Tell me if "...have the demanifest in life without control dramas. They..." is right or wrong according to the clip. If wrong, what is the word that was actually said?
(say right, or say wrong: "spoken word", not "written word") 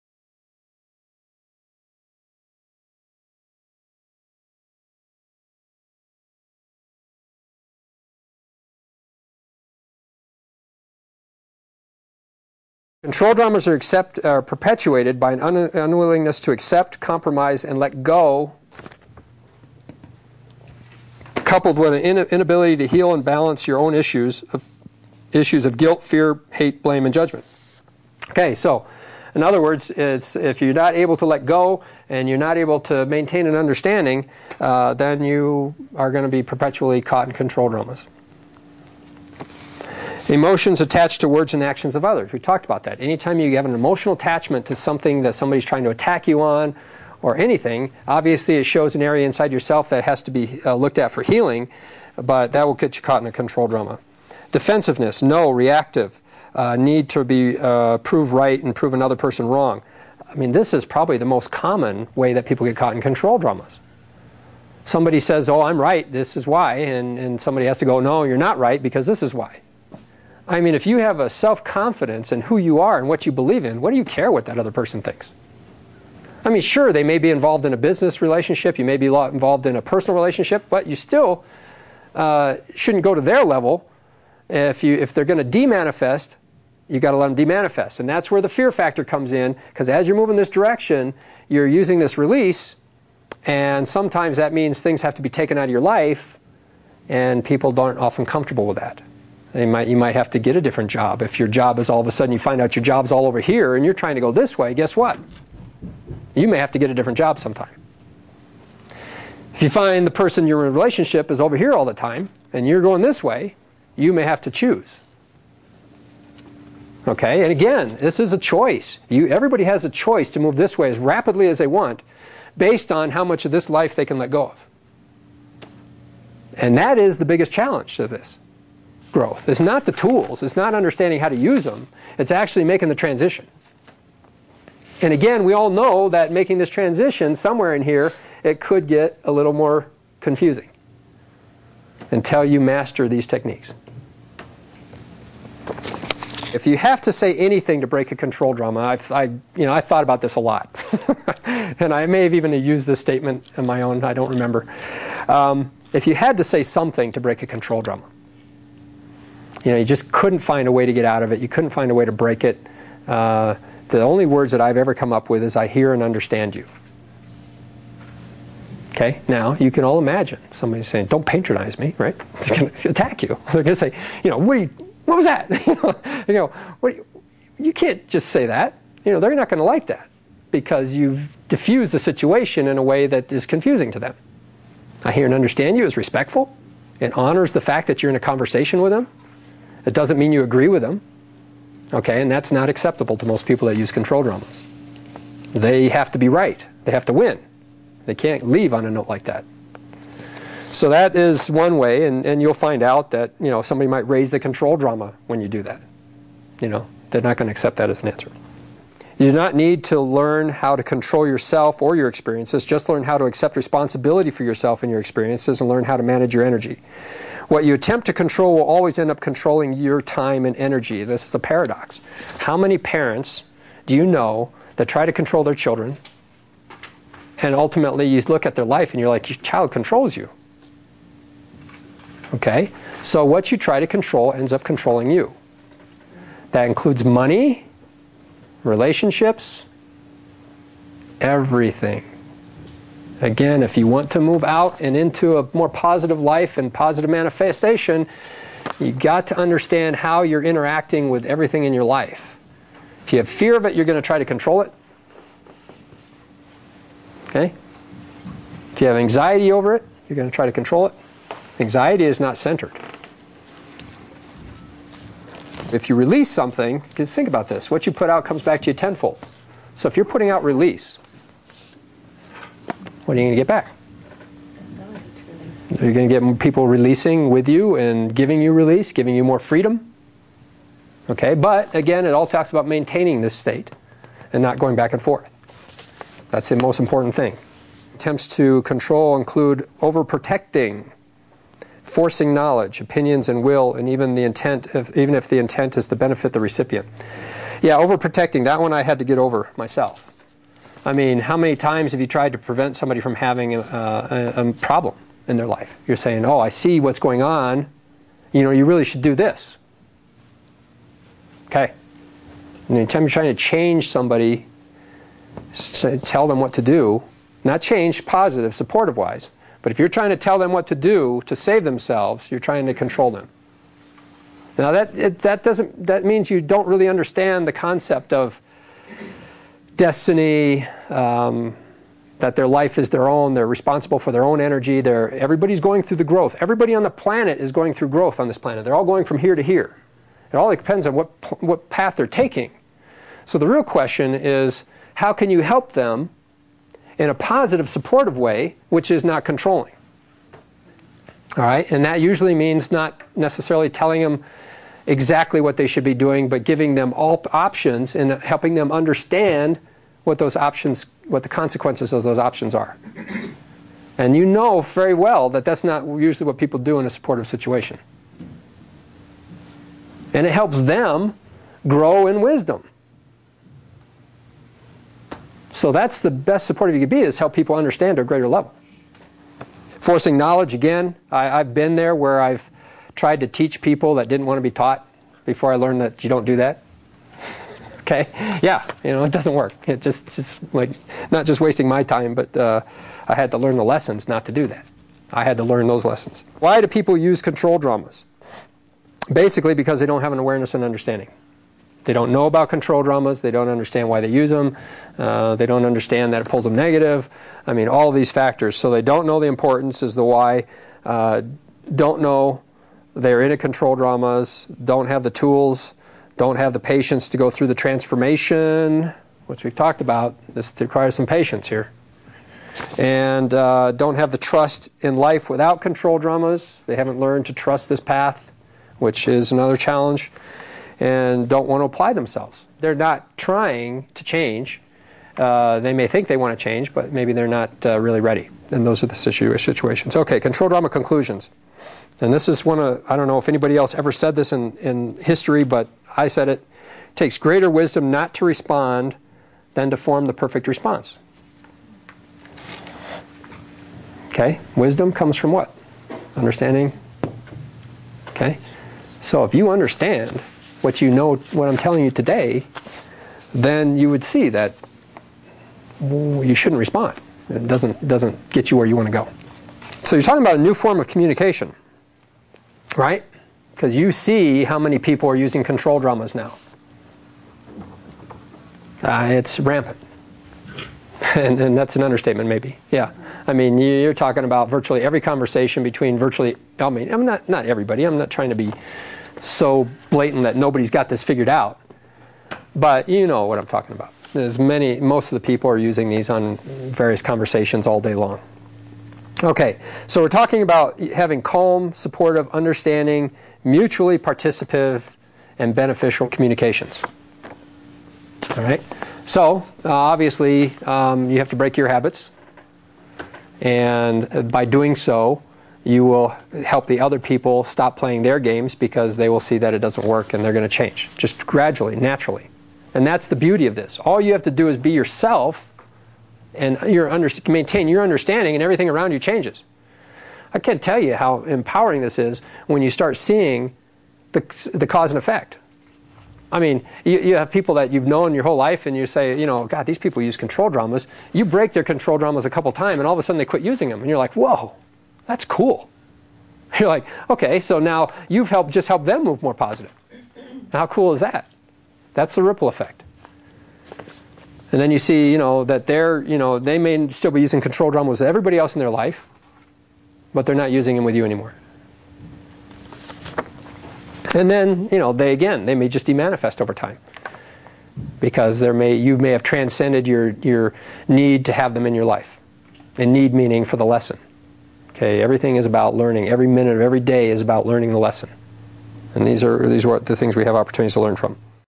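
wrong: "trust", not "demanifest".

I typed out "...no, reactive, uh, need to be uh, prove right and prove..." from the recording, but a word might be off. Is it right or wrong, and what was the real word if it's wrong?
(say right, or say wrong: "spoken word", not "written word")
right.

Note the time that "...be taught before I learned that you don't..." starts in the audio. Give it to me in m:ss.
6:24.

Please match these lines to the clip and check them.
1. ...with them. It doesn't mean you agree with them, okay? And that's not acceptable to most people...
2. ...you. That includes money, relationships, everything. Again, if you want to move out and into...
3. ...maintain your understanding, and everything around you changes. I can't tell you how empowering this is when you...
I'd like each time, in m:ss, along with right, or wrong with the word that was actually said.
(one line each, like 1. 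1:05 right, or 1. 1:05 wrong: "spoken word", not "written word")
1. 3:08 right
2. 3:55 right
3. 8:47 right.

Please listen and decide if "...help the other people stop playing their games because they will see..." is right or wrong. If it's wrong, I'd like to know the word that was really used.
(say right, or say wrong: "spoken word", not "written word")
right.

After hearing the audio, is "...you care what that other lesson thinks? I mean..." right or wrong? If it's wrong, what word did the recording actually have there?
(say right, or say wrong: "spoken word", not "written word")
wrong: "person", not "lesson".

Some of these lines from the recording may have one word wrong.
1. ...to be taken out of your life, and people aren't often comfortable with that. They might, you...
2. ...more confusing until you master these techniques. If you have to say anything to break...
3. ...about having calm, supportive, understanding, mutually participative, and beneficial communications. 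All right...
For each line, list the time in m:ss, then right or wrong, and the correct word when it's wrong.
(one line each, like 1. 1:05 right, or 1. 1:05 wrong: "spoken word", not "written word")
1. 1:35 right
2. 2:19 right
3. 8:20 right.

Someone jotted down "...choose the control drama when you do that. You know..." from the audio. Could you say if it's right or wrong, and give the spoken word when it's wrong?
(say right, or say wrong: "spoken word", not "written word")
wrong: "raise", not "choose".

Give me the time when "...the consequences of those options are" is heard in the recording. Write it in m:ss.
6:01.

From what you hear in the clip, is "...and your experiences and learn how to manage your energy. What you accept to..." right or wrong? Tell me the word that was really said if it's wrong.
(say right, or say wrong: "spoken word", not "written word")
wrong: "attempt", not "accept".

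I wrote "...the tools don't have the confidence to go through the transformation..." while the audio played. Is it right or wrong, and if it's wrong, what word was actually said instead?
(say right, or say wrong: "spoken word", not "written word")
wrong: "patience", not "confidence".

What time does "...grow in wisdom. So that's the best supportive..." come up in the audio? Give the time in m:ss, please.
6:11.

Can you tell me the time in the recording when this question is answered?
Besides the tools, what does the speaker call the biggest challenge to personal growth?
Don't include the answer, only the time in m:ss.
2:12.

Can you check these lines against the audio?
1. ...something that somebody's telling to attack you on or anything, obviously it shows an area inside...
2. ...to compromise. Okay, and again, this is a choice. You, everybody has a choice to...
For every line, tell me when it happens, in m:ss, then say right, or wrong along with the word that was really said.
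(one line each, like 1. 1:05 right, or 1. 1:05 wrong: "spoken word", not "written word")
1. 0:44 wrong: "trying", not "telling"
2. 1:54 wrong: "choose", not "compromise".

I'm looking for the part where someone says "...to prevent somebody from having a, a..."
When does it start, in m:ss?
5:02.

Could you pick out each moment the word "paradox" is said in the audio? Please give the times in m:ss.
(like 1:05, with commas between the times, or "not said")
3:41.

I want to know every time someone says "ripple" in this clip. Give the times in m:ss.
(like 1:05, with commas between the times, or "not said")
9:12.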